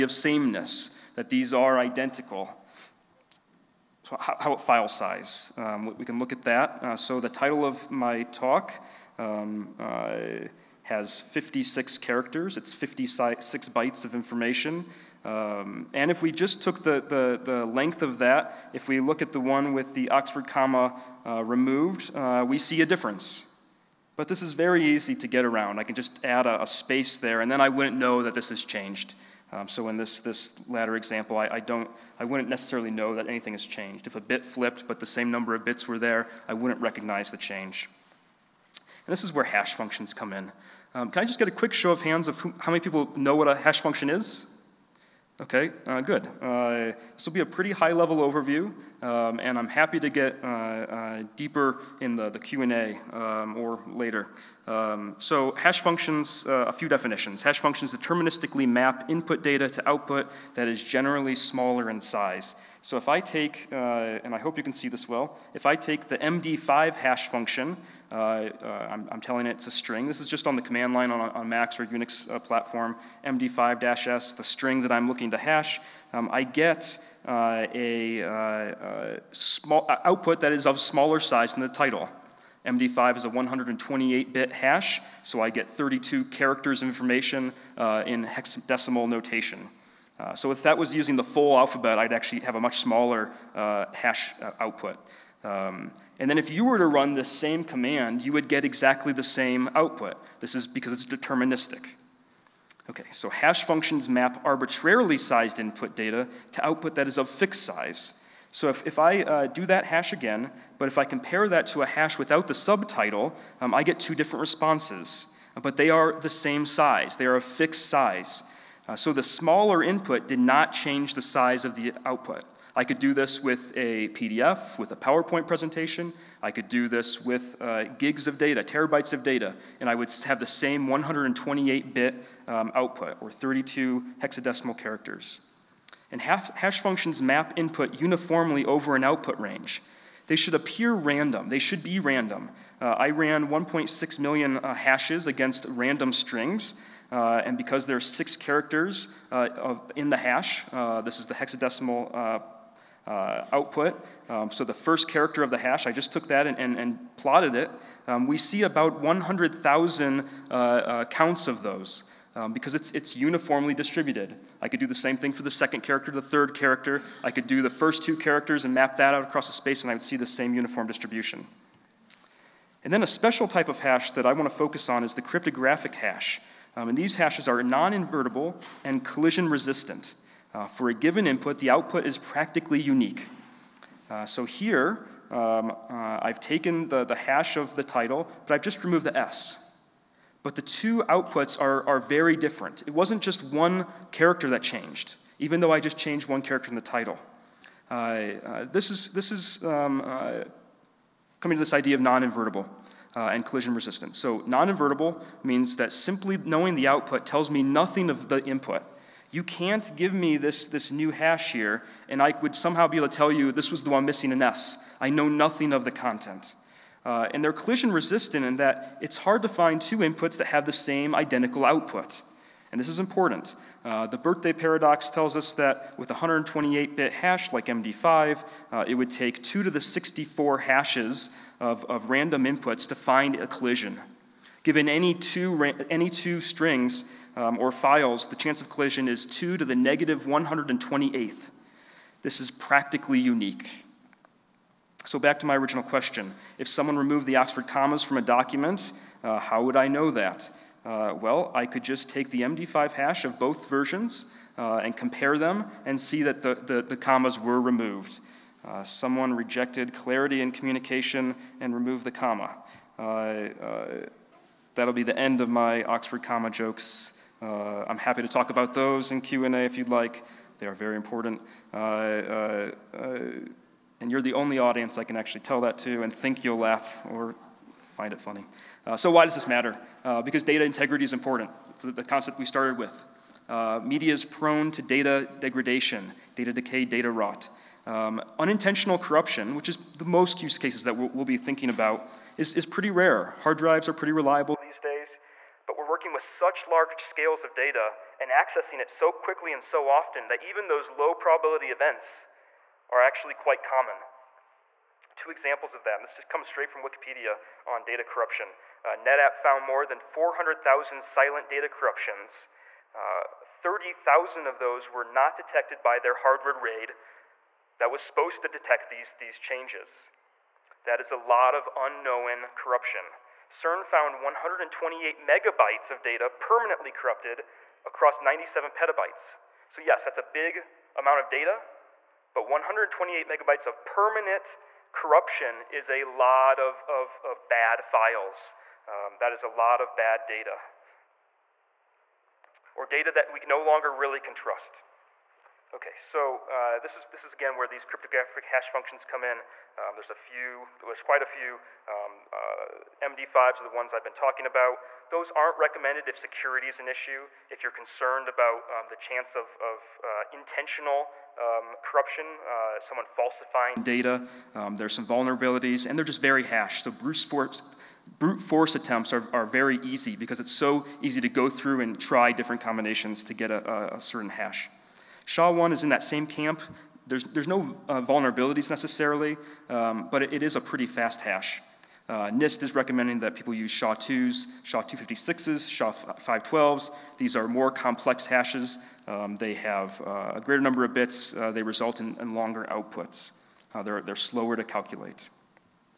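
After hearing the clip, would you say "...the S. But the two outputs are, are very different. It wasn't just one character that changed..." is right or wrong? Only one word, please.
right.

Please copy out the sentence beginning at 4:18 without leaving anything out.
Uh, someone rejected clarity in communication and removed the comma.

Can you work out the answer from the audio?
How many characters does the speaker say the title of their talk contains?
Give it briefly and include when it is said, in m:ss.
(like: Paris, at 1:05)
56, at 0:11.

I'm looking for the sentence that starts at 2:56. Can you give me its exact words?
Um, and these hashes are non-invertible and collision resistant.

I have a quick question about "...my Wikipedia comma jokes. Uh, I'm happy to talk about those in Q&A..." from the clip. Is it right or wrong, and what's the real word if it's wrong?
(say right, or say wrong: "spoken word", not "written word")
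wrong: "Oxford", not "Wikipedia".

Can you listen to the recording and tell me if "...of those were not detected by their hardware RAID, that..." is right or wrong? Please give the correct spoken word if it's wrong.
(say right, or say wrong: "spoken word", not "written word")
right.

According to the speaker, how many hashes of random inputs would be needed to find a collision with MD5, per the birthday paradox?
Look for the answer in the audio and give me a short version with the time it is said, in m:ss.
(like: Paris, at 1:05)
2 to the 64, at 3:49.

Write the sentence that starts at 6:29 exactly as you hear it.
Um, they have uh, a greater number of bits.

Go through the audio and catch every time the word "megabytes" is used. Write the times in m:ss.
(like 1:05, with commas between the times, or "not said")
5:25, 5:33.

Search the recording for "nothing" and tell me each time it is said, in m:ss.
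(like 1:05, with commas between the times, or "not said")
3:27, 3:35.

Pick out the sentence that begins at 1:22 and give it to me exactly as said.
MD5 is a 128-bit hash, so I get 32 characters of information in hexadecimal notation.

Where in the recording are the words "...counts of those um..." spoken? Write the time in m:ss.
2:41.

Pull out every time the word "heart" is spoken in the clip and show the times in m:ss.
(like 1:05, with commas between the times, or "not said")
not said.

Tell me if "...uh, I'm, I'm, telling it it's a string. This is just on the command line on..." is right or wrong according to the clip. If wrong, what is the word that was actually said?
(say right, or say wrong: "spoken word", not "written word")
right.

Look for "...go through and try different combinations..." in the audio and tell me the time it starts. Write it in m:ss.
6:11.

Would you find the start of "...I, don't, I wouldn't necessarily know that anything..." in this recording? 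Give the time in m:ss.
0:31.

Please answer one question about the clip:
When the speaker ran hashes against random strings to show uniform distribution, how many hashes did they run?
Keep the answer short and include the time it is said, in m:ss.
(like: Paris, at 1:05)
1.6 million, at 2:23.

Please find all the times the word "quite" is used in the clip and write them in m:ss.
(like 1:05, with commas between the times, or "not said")
5:03, 5:51.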